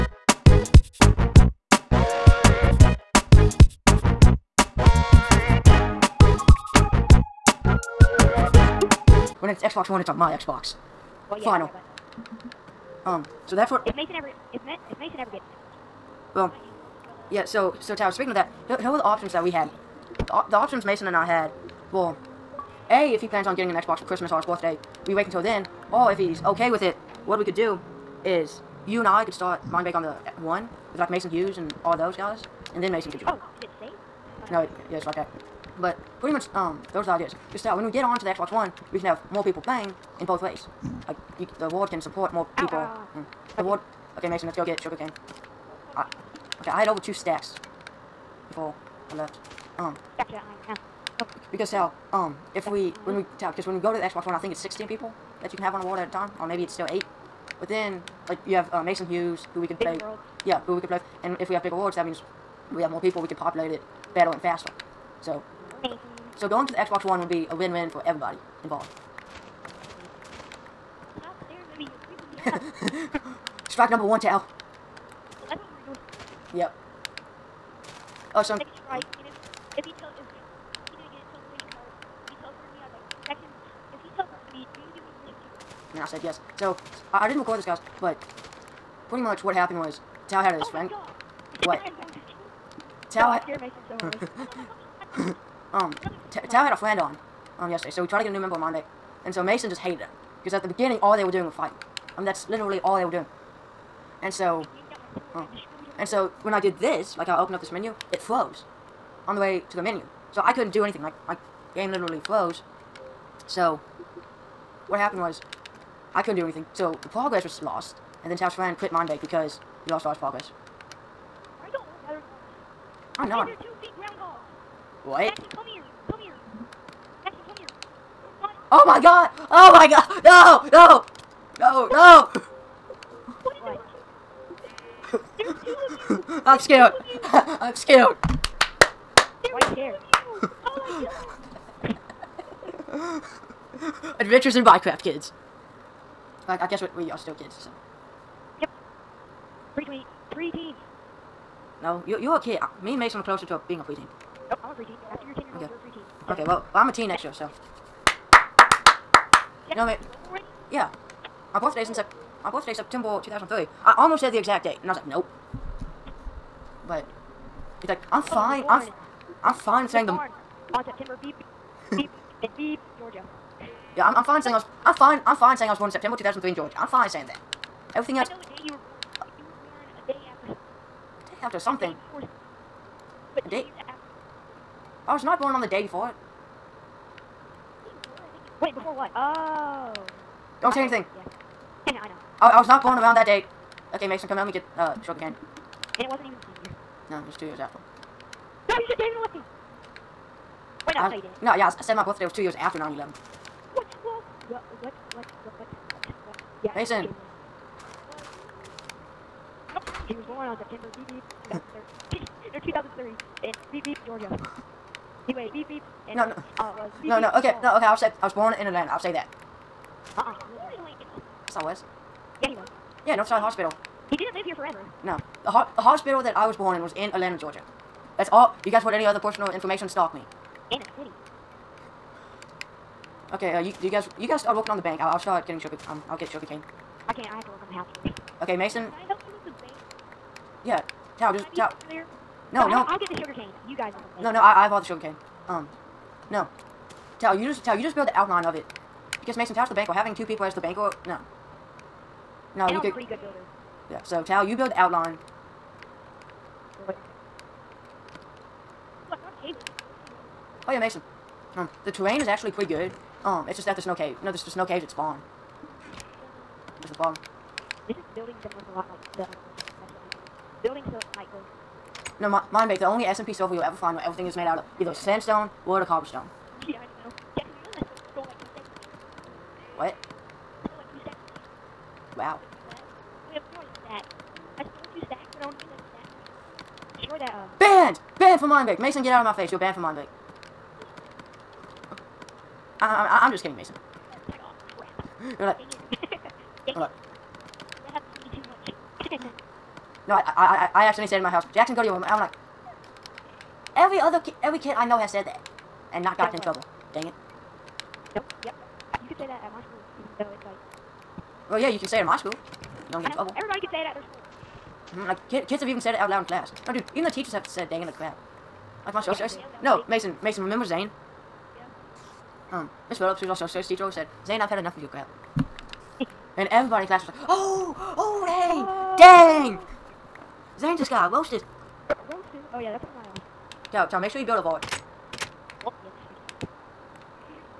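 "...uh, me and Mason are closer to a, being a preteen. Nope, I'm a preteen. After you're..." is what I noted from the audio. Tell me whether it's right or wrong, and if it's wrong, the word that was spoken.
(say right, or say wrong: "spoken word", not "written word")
right.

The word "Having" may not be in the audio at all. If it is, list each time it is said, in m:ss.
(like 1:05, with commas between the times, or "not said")
4:09.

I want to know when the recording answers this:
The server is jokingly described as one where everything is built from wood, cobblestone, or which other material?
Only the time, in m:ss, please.
4:34.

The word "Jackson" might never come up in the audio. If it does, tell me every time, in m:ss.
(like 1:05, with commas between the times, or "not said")
4:37, 5:01.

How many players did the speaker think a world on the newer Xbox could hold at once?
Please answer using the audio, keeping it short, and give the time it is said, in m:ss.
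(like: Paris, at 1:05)
16, at 0:54.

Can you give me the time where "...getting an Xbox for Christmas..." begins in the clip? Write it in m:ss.
0:23.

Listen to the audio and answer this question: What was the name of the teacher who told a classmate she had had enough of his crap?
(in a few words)
Miss Phillips.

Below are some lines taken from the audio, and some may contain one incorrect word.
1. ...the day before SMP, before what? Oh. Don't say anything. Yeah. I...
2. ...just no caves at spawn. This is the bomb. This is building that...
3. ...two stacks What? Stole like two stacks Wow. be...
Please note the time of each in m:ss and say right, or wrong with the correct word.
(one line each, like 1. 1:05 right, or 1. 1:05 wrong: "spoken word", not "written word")
1. 3:05 wrong: "Wait", not "SMP"
2. 4:24 right
3. 4:38 right.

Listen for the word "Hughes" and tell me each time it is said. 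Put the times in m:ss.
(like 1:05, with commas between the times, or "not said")
0:31, 0:59.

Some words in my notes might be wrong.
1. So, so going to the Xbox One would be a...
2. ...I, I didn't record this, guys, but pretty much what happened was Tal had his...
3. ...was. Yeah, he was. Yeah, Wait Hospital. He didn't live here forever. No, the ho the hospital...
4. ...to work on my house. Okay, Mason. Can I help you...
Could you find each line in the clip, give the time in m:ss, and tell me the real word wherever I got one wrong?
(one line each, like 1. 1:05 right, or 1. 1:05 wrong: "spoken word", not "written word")
1. 1:05 right
2. 1:27 right
3. 3:41 wrong: "Northside", not "Wait"
4. 3:57 right.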